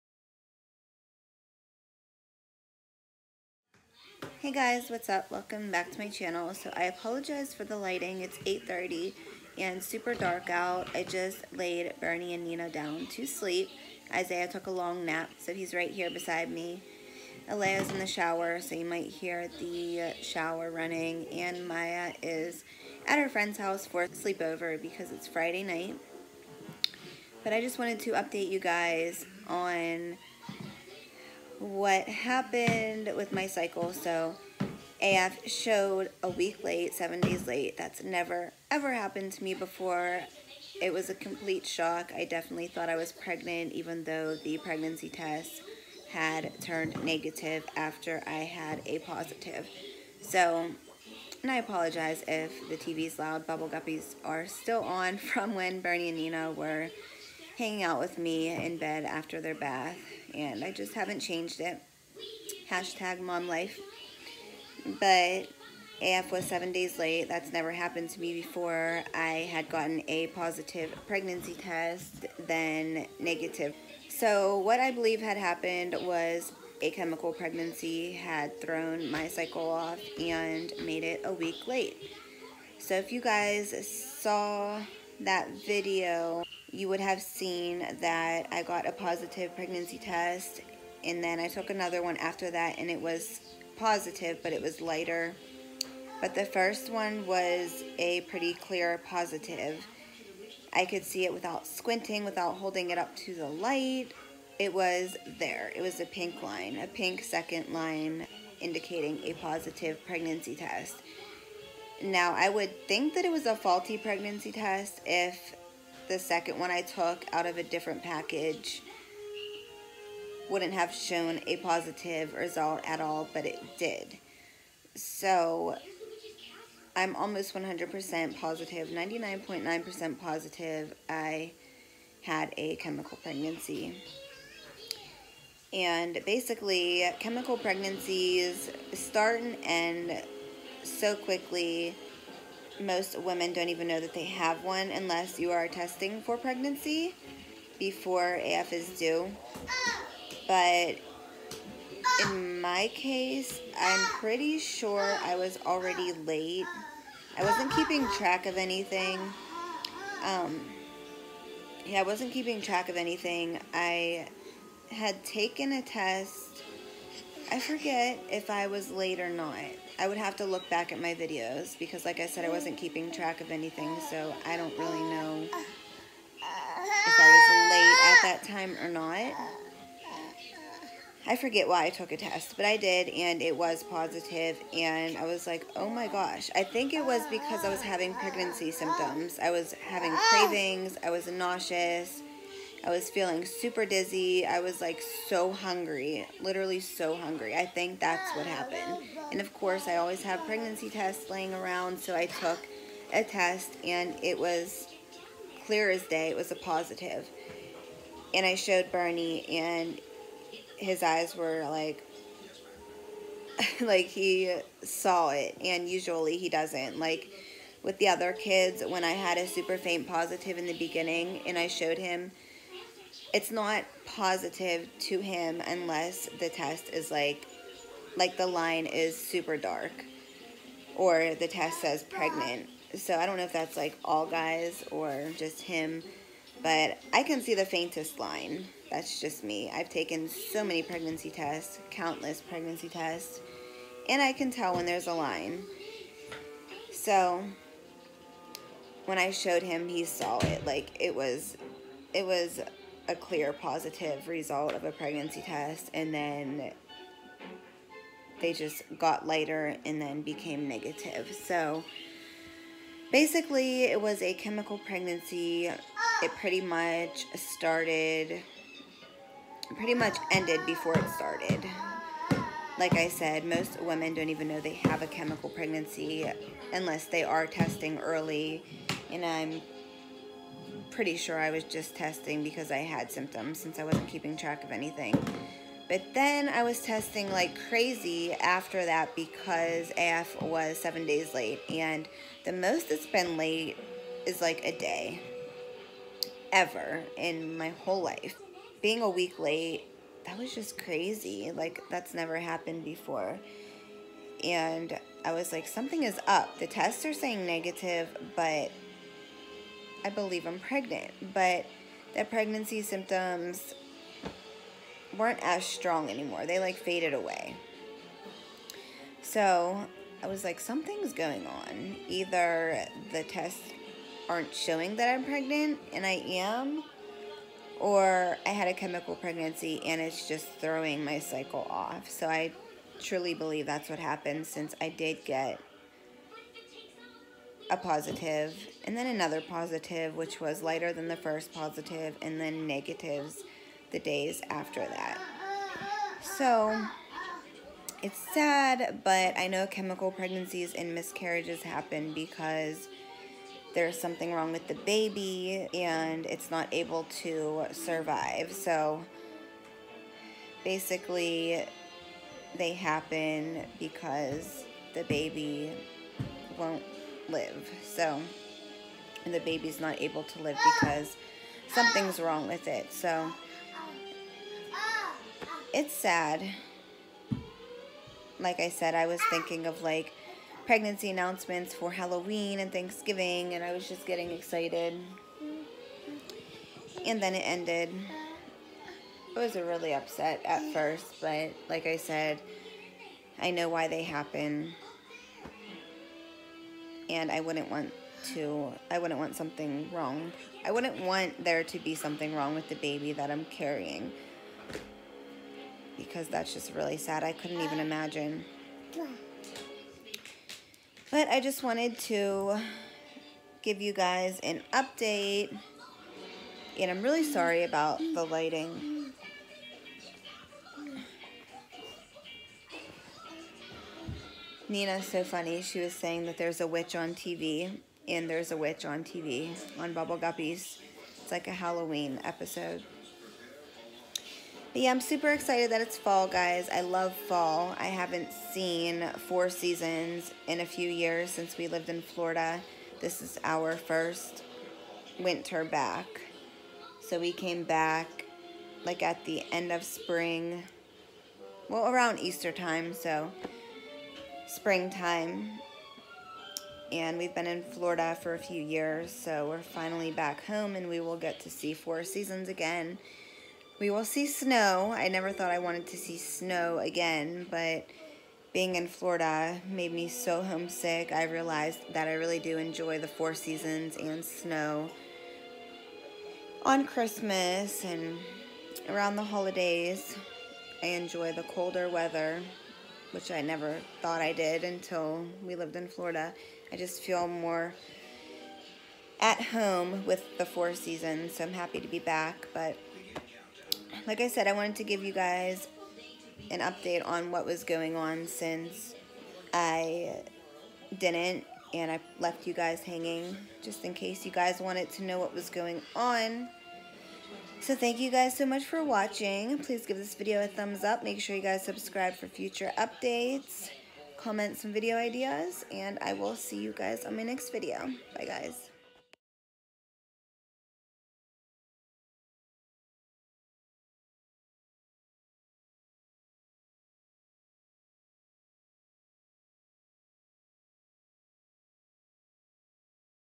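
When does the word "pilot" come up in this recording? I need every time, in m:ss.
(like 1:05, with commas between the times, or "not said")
not said.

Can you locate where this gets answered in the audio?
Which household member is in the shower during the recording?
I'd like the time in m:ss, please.
0:17.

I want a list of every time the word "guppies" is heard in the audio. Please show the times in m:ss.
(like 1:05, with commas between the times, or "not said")
0:53, 7:10.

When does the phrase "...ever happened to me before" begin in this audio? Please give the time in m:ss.
0:38.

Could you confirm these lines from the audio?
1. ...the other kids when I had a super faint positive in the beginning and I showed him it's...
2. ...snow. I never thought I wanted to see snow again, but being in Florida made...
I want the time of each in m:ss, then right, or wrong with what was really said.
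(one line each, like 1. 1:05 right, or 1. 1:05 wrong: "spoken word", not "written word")
1. 3:37 right
2. 7:44 right.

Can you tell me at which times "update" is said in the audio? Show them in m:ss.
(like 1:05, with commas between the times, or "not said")
0:28, 6:54, 8:16, 8:32.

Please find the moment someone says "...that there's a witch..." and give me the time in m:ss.
7:06.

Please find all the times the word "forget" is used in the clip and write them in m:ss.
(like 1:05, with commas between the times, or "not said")
2:47, 3:01.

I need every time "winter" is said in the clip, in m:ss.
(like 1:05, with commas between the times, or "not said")
7:25.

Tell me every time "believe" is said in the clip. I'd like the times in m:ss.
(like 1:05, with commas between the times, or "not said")
1:14, 5:10, 5:33.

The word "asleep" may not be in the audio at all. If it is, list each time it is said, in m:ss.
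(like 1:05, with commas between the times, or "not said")
not said.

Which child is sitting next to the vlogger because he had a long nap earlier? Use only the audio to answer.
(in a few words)
Isaiah.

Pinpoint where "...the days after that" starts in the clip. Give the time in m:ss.
5:43.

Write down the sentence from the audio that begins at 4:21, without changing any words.
So basically it was a chemical pregnancy.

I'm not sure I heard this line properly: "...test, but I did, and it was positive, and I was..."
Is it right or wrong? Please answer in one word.
right.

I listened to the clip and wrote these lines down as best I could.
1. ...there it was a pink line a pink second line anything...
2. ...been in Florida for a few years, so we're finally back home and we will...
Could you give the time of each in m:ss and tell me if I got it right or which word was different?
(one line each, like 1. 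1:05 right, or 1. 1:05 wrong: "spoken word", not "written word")
1. 1:45 wrong: "indicating", not "anything"
2. 7:37 right.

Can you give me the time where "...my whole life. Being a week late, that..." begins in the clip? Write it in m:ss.
4:57.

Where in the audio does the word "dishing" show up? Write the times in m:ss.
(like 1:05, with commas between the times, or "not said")
not said.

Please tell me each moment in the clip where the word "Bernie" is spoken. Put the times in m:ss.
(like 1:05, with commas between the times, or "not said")
0:12, 0:55, 3:28.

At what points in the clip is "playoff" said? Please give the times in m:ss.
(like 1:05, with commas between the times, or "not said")
not said.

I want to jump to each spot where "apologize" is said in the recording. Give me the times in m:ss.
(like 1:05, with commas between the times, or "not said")
0:06, 0:51.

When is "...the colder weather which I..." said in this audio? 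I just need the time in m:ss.
8:01.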